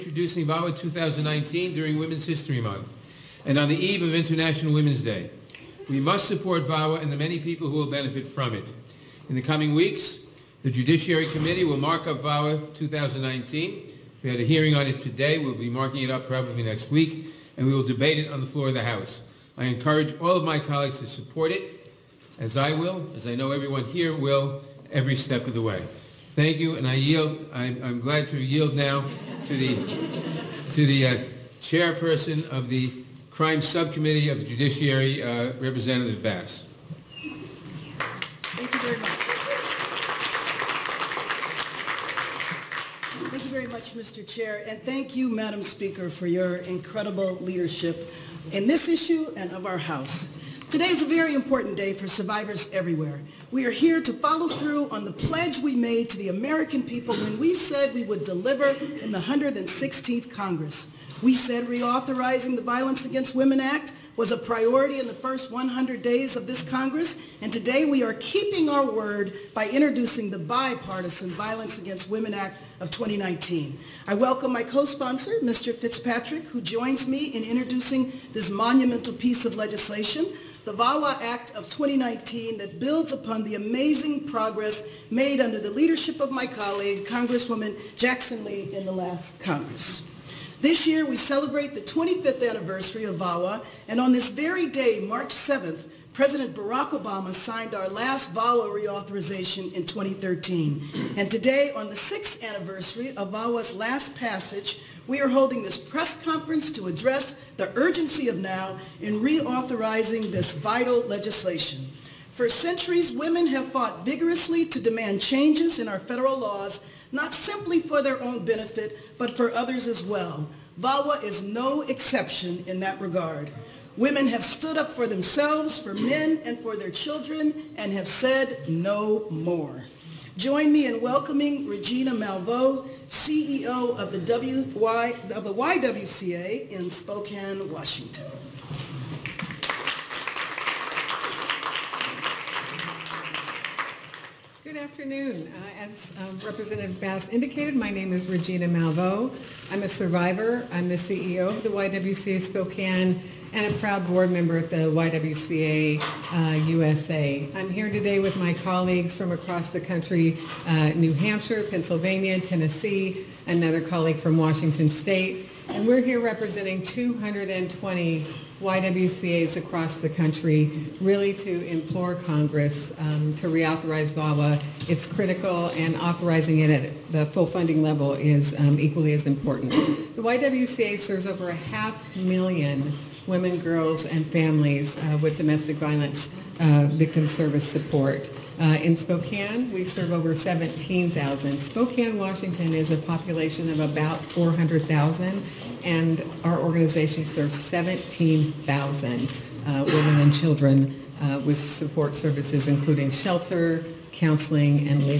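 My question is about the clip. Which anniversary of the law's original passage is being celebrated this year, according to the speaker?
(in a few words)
25th.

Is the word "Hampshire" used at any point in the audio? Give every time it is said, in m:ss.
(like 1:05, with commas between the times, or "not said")
2:41.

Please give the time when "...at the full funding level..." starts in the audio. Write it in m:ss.
2:56.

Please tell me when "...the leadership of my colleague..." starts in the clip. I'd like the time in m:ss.
1:25.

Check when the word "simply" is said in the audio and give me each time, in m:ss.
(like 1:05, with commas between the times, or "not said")
1:57.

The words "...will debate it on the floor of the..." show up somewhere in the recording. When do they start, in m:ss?
0:17.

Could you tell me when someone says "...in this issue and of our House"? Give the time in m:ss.
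0:48.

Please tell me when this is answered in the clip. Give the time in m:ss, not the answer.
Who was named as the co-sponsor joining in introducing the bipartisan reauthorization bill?
1:15.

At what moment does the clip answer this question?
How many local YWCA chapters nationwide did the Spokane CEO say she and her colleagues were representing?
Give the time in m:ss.
2:46.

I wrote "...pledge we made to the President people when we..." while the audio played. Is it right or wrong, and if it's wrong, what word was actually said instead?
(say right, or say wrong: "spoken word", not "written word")
wrong: "American", not "President".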